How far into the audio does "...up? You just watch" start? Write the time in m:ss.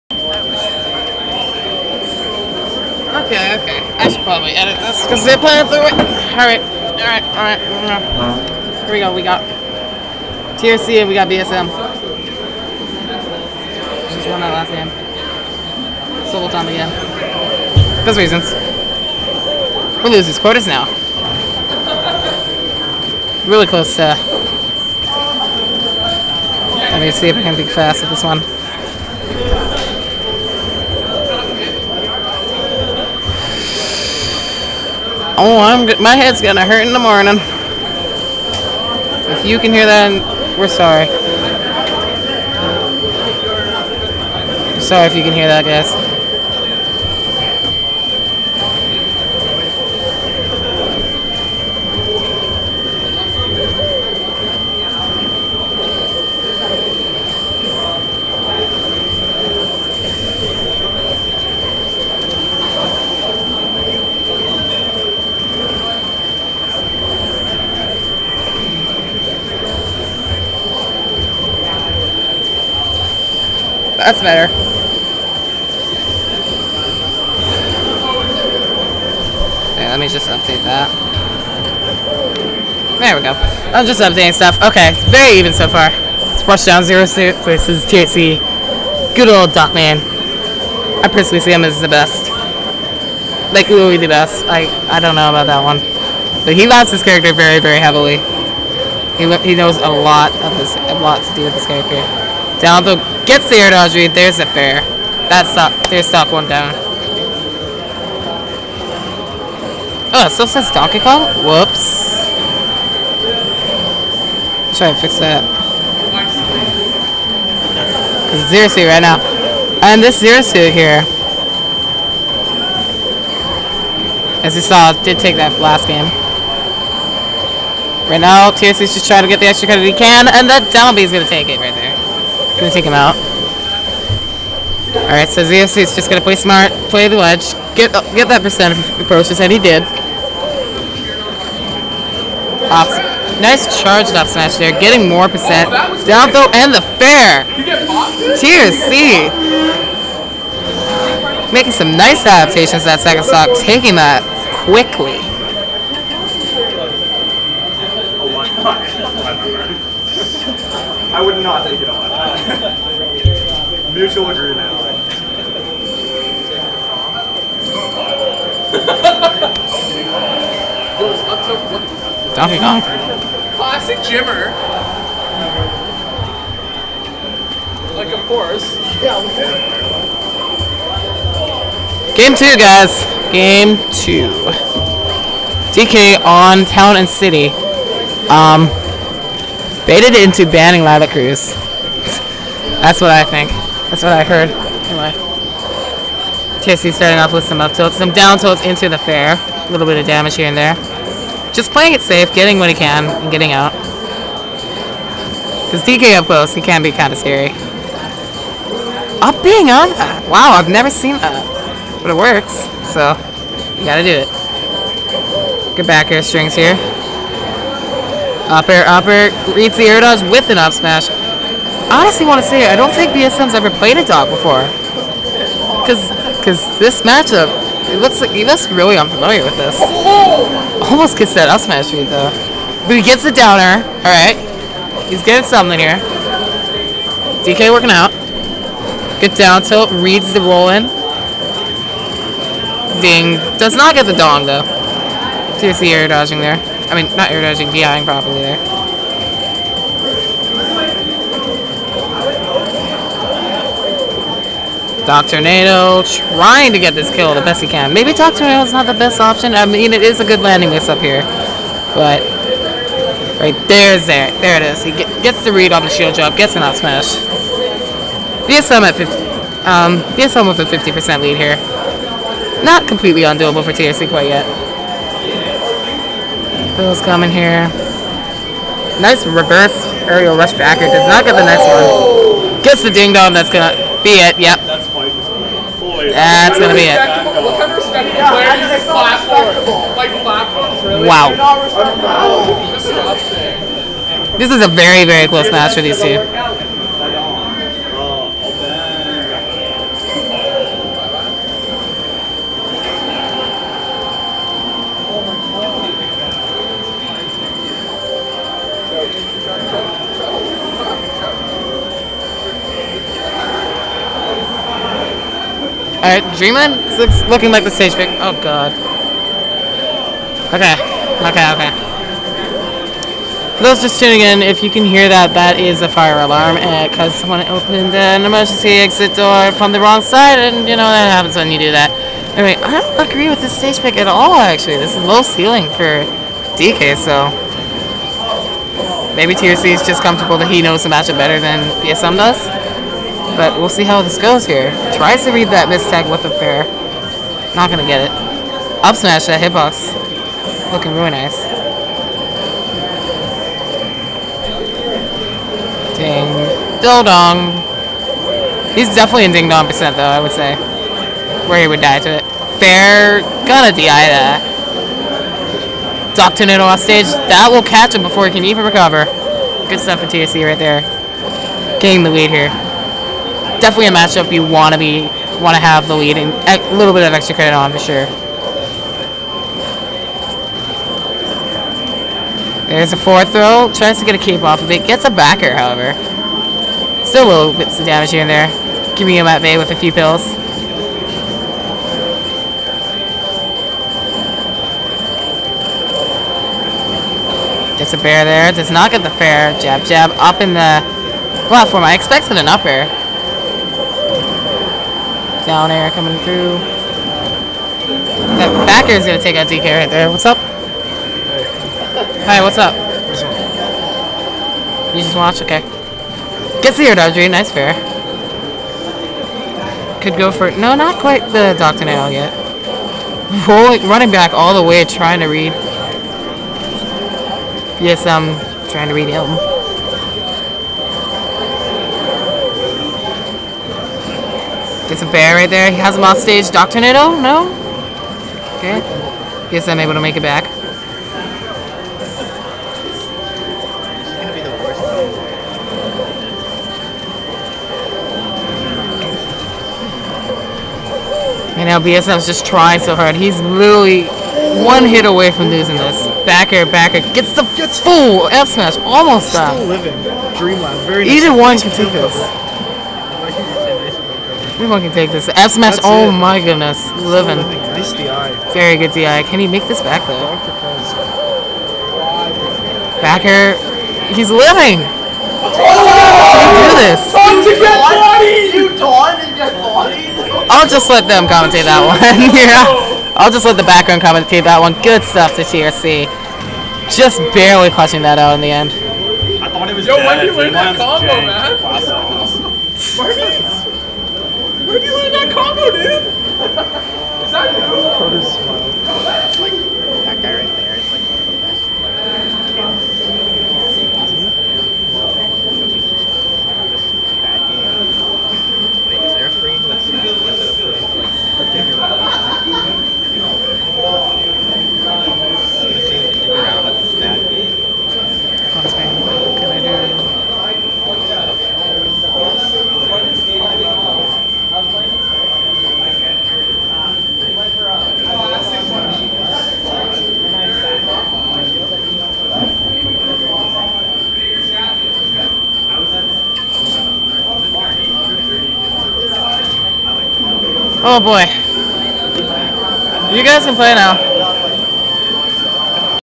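6:52.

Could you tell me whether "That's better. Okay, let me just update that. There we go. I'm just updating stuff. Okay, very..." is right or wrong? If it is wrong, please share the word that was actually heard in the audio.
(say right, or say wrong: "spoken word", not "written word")
right.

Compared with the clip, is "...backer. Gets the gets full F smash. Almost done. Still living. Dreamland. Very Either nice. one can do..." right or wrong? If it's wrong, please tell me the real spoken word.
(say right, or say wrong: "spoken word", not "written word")
right.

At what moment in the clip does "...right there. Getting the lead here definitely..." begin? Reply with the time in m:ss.
6:10.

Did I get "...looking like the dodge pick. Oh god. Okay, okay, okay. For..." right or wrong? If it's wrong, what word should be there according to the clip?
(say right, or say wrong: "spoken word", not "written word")
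wrong: "stage", not "dodge".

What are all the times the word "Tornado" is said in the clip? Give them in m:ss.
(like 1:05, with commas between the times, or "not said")
6:06, 7:16.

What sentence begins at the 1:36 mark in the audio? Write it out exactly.
But he loves his character very, very heavily.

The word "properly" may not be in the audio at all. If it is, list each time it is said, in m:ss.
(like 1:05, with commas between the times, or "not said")
4:08.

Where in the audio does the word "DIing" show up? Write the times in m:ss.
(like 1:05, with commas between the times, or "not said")
4:07.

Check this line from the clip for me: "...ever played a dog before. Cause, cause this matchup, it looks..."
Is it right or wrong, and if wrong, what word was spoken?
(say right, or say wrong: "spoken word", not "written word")
right.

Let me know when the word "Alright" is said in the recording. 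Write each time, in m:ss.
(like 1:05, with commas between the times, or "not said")
2:14, 5:16.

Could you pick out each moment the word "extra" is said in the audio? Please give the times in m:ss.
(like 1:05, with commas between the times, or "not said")
2:09, 6:17.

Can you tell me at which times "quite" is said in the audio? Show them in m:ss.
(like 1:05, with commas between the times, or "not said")
4:34, 7:00.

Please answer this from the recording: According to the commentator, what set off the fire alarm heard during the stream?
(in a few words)
An emergency exit door.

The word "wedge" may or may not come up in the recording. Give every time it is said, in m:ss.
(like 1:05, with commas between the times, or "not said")
2:17.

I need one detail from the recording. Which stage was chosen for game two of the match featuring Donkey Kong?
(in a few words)
Town and City.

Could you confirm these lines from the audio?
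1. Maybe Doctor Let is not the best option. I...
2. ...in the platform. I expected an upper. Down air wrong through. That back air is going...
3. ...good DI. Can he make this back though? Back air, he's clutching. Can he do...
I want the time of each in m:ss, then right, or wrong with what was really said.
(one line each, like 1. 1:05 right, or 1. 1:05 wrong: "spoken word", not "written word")
1. 4:17 wrong: "Nado", not "Let"
2. 6:40 wrong: "coming", not "wrong"
3. 7:48 wrong: "living", not "clutching".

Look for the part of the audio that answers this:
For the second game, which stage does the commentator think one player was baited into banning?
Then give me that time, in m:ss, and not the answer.
3:10.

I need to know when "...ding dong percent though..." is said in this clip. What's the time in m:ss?
5:59.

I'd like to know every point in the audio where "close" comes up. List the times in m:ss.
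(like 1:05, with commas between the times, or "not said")
0:23, 3:26, 4:55.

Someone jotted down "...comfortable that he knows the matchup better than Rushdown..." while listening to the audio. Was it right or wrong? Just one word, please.
wrong.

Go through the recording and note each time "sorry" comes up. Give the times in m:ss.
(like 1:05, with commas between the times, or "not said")
0:40, 0:44.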